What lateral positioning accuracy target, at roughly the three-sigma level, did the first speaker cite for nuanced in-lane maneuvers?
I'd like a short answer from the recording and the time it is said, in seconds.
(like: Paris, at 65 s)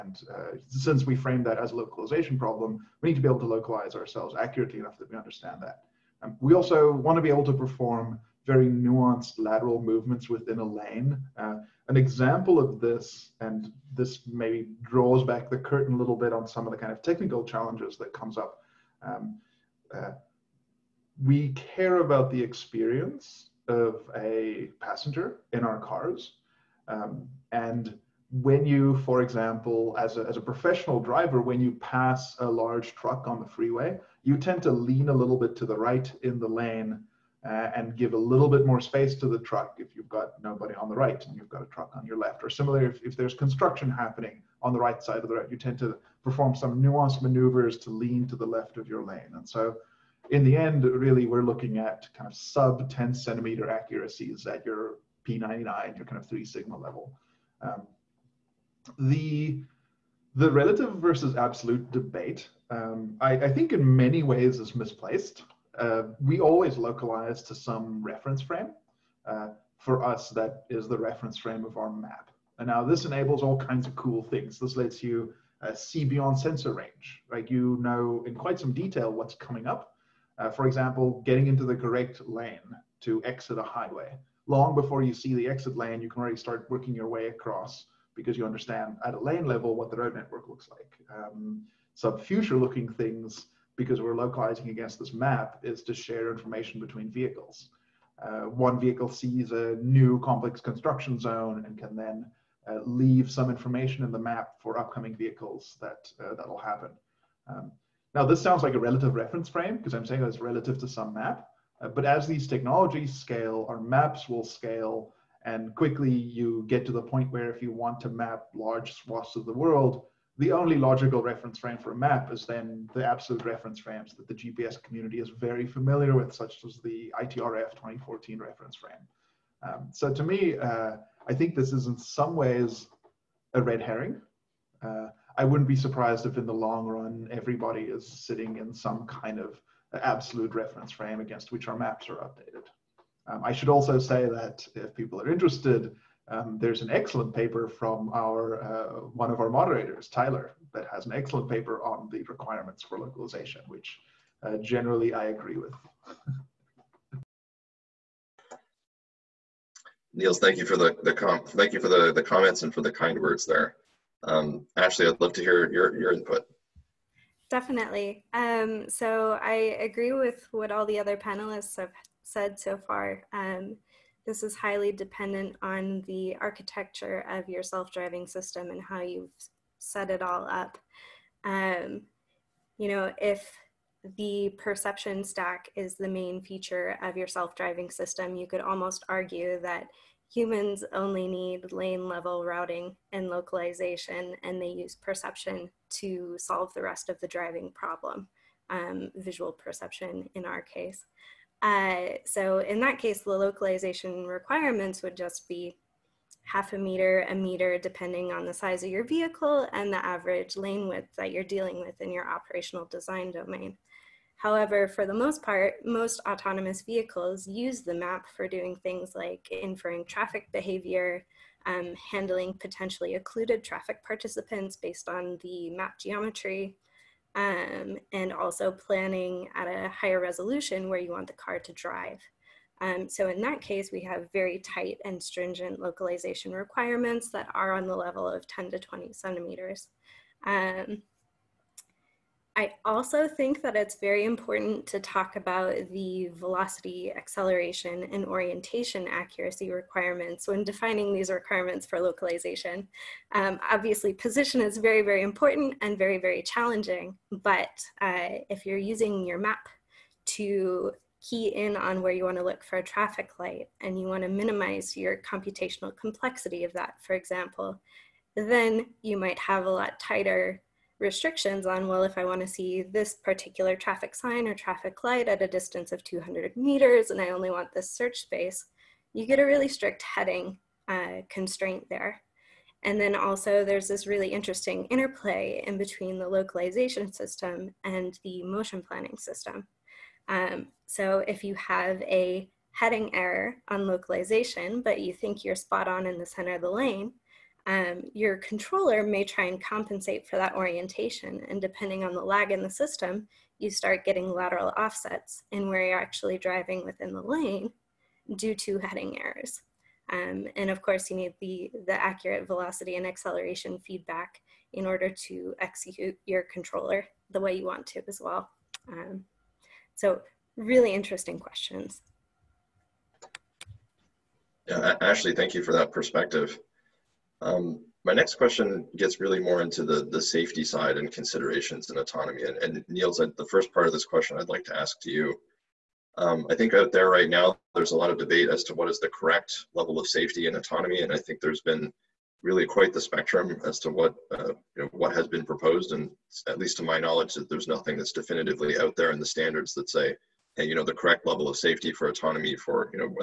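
sub 10 centimeter, at 52 s.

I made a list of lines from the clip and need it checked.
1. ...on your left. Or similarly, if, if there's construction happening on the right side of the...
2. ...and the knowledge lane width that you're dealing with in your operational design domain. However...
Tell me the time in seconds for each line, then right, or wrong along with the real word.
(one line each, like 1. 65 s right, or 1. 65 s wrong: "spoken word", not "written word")
1. 41 s right
2. 209 s wrong: "average", not "knowledge".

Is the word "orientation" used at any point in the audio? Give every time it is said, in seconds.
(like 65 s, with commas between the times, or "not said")
248 s, 300 s.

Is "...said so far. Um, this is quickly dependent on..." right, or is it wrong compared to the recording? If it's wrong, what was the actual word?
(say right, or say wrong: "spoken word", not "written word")
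wrong: "highly", not "quickly".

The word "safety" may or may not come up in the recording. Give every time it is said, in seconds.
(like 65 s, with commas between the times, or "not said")
330 s, 340 s, 351 s.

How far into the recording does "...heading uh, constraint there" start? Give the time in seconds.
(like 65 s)
280 s.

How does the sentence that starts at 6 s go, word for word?
Um, we also want to be able to perform very nuanced lateral movements within a lane.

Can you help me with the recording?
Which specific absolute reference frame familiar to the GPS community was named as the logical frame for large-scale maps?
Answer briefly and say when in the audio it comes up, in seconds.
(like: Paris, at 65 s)
ITRF 2014, at 127 s.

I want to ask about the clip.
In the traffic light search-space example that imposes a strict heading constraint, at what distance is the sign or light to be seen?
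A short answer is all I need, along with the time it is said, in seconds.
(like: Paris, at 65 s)
200 meters, at 276 s.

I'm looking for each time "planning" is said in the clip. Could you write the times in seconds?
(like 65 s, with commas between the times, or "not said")
228 s, 288 s.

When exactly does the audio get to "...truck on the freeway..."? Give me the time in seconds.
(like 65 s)
32 s.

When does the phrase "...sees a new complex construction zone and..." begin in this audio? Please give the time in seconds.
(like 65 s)
99 s.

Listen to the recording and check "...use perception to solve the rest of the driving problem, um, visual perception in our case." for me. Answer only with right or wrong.
right.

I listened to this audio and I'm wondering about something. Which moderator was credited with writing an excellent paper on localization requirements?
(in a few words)
Tyler.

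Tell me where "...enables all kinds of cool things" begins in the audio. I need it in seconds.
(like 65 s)
73 s.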